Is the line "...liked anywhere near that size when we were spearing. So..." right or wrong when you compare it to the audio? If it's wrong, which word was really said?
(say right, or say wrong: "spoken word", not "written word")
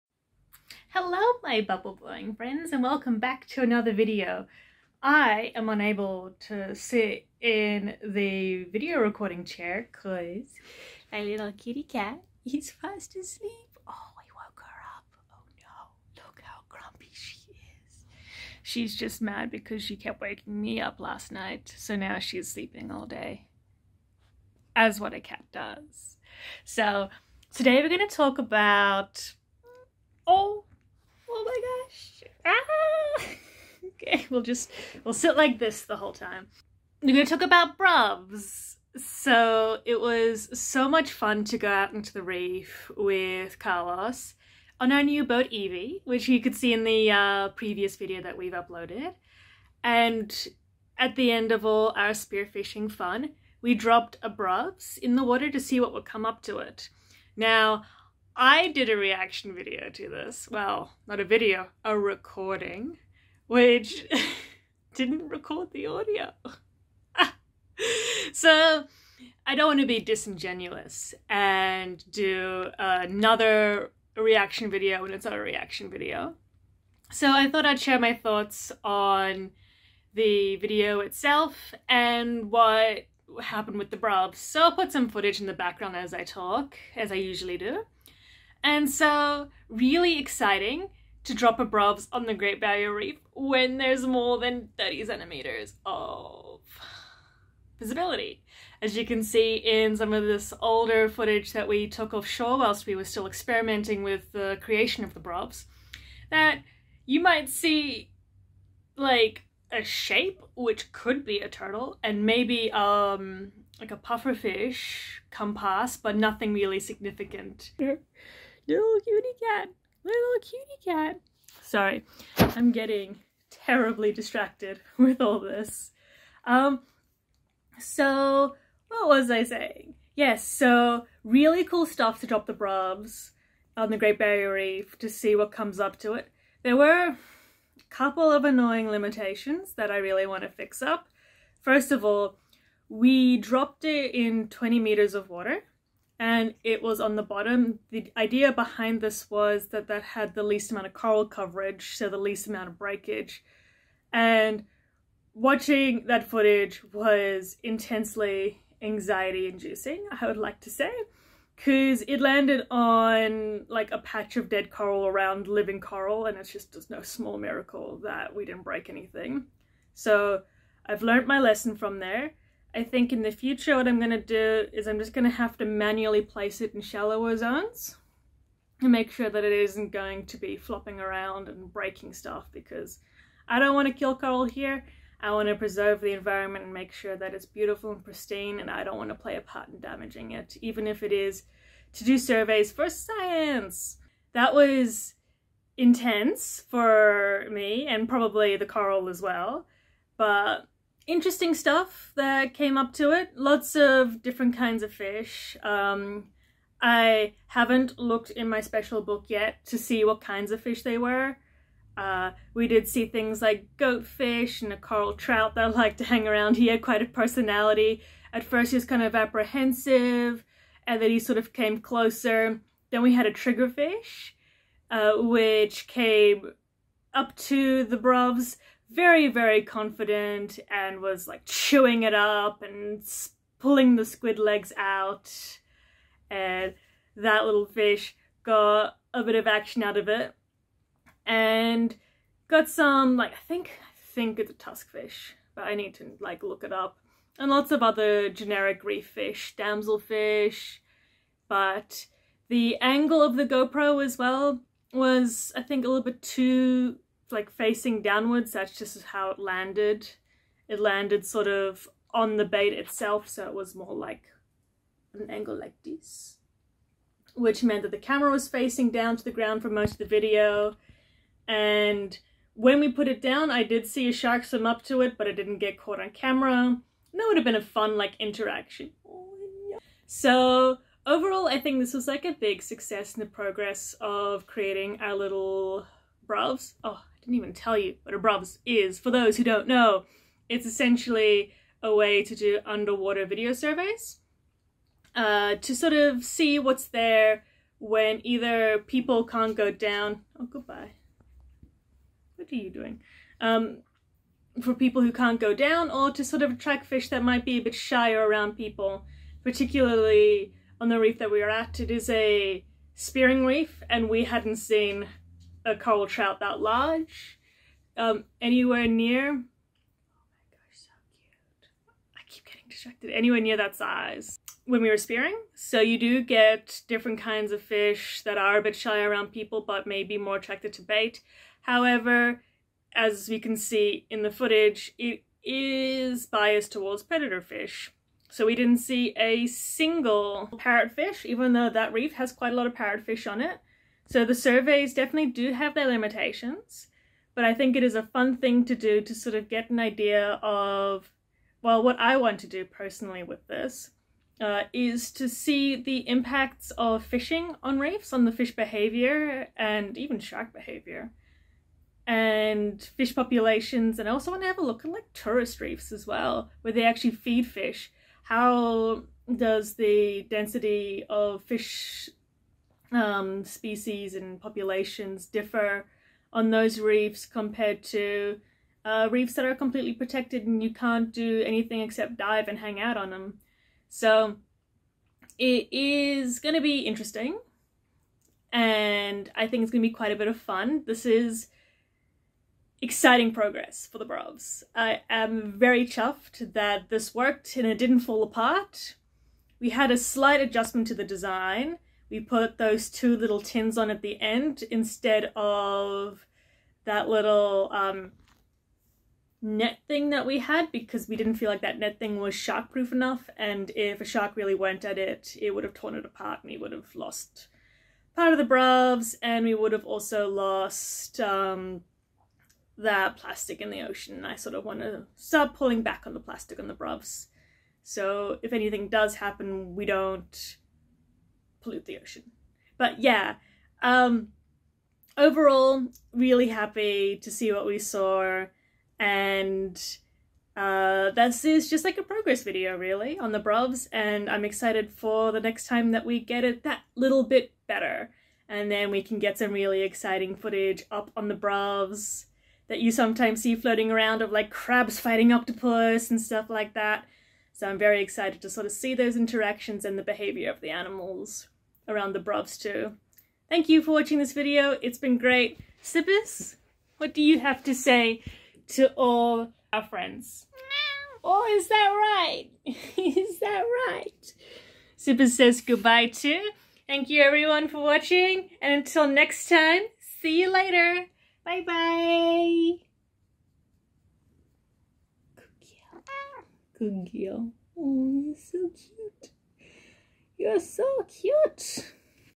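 wrong: "distracted", not "liked".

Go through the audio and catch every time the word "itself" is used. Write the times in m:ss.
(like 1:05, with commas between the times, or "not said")
1:21, 4:22.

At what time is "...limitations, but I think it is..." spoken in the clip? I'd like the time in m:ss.
5:45.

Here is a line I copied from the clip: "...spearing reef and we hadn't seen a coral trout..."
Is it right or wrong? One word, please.
right.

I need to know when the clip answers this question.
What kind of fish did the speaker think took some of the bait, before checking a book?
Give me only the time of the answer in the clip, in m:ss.
4:04.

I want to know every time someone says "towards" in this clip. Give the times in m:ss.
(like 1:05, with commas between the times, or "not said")
5:36.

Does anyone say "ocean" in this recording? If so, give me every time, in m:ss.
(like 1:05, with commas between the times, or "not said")
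7:03, 7:11.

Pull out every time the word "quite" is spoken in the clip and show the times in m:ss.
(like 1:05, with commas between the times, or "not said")
3:36, 5:42, 6:29.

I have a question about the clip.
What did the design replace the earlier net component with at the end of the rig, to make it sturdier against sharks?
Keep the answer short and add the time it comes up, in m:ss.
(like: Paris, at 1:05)
two little tins, at 6:42.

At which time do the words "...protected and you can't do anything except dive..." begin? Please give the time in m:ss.
6:19.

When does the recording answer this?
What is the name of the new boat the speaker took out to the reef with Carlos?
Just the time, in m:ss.
0:45.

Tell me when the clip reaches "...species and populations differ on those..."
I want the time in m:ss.
6:13.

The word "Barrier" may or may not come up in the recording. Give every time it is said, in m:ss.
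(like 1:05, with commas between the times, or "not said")
1:32, 2:14.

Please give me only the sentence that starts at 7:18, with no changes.
And uh, this is just like a progress video, really, on the Bruvs.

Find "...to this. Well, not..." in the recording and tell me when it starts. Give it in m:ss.
0:59.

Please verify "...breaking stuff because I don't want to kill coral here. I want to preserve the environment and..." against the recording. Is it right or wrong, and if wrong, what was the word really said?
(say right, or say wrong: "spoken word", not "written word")
right.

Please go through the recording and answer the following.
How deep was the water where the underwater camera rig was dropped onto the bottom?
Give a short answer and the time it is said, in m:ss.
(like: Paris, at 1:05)
20 meters, at 2:24.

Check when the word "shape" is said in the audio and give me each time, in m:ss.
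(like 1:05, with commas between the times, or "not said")
1:49.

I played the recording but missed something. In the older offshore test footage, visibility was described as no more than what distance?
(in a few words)
30 centimeters.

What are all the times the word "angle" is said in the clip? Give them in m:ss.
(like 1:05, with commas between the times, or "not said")
4:12, 4:25.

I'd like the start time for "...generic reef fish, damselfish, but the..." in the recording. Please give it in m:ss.
4:08.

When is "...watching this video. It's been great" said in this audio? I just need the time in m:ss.
7:43.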